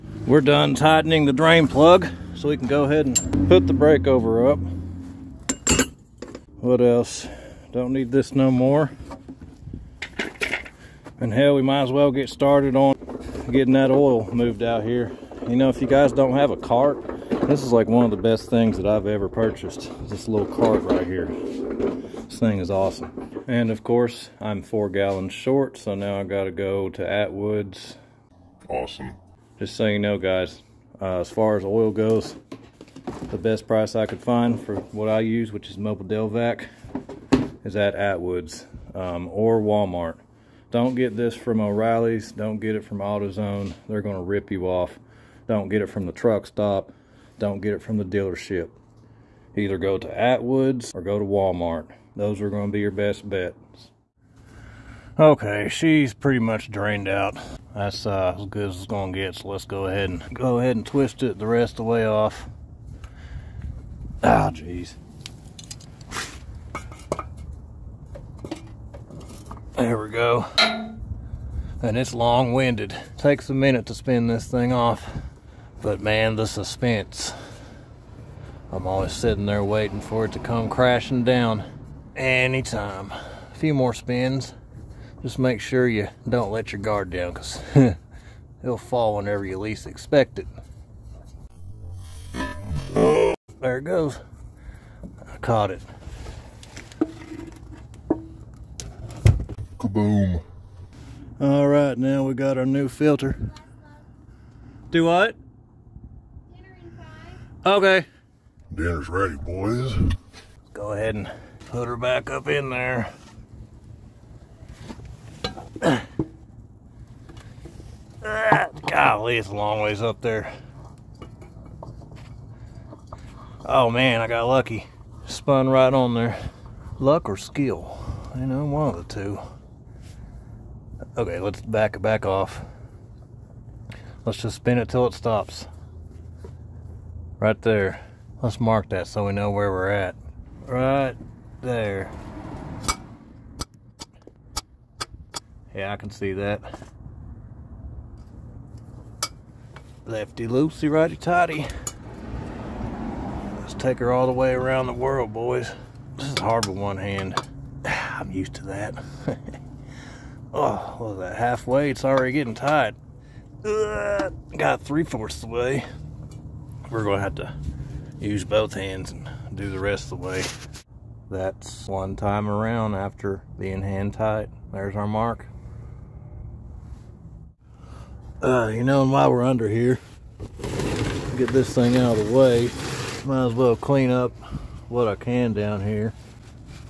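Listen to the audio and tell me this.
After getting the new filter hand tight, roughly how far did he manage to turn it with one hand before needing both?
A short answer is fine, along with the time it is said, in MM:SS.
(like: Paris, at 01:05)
three fourths, at 02:44.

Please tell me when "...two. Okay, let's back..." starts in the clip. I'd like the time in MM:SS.
02:09.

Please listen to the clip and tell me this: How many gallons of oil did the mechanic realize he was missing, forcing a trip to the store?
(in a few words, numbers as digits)
4.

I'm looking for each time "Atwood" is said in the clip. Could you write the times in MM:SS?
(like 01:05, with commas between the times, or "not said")
00:27, 00:37, 00:50.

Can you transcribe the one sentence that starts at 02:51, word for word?
That's one time around after being hand tight.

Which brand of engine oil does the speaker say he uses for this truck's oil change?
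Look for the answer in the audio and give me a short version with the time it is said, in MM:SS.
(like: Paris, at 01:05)
Mobil Delvac, at 00:35.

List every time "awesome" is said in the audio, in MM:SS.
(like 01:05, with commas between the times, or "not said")
00:22, 00:28.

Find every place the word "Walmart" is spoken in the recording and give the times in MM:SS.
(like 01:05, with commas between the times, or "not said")
00:39, 00:51.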